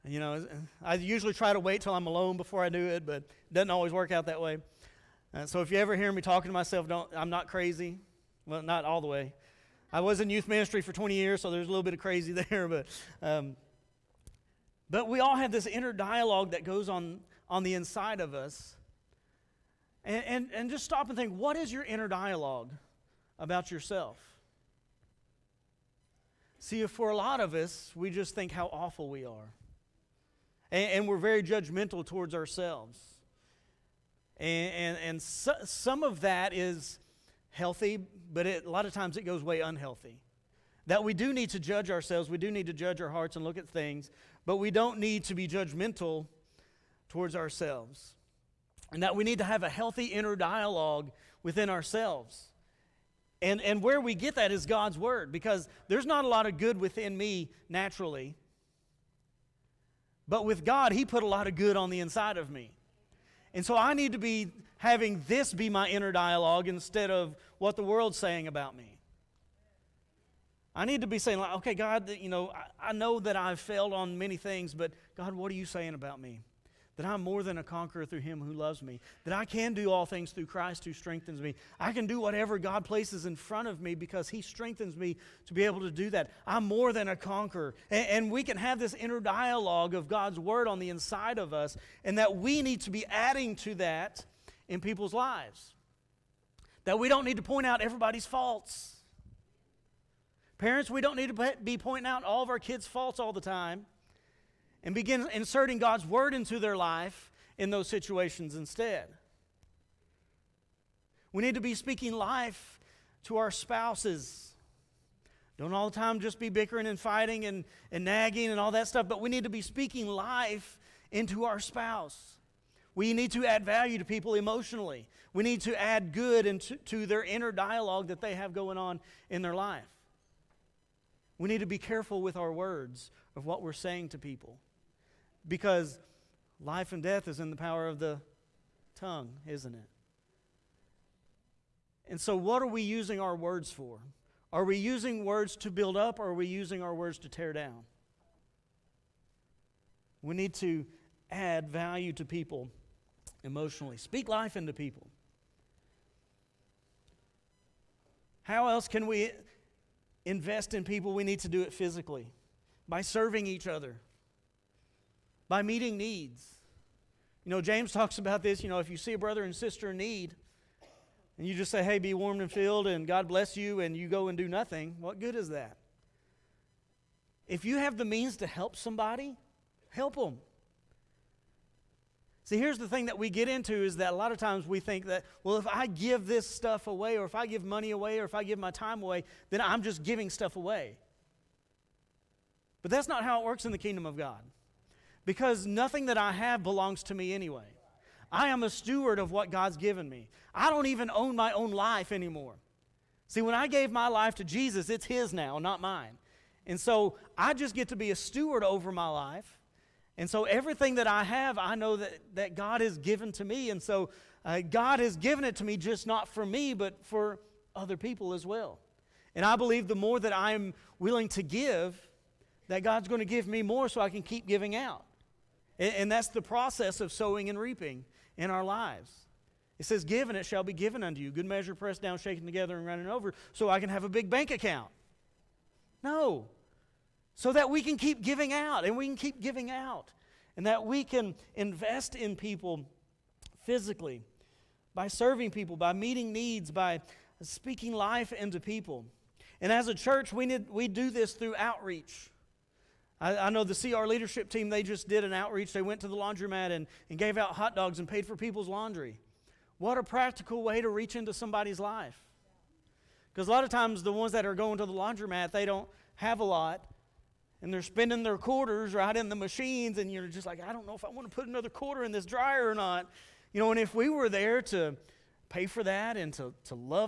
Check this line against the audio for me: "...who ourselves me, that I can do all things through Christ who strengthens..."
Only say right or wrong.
wrong.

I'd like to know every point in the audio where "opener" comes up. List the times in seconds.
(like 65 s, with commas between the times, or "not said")
not said.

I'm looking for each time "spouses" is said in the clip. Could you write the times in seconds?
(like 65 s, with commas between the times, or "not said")
113 s, 121 s.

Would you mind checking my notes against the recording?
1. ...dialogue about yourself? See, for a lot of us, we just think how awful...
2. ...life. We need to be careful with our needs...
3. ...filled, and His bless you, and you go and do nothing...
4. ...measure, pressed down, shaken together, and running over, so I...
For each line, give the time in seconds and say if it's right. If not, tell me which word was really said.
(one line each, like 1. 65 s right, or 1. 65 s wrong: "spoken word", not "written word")
1. 22 s right
2. 129 s wrong: "words", not "needs"
3. 172 s wrong: "God", not "His"
4. 231 s right.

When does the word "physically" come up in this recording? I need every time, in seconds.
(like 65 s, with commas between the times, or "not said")
161 s, 243 s.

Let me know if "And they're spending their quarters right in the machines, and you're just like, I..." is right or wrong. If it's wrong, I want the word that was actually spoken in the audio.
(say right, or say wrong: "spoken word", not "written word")
right.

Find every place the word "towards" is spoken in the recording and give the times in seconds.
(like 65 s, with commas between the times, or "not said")
32 s, 47 s.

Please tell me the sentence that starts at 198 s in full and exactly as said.
I am a steward of what God's given me.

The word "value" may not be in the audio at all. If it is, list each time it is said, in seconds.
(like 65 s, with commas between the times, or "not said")
123 s, 151 s.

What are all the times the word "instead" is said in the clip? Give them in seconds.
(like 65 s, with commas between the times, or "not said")
66 s, 108 s.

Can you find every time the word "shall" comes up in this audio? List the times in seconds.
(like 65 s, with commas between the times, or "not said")
230 s.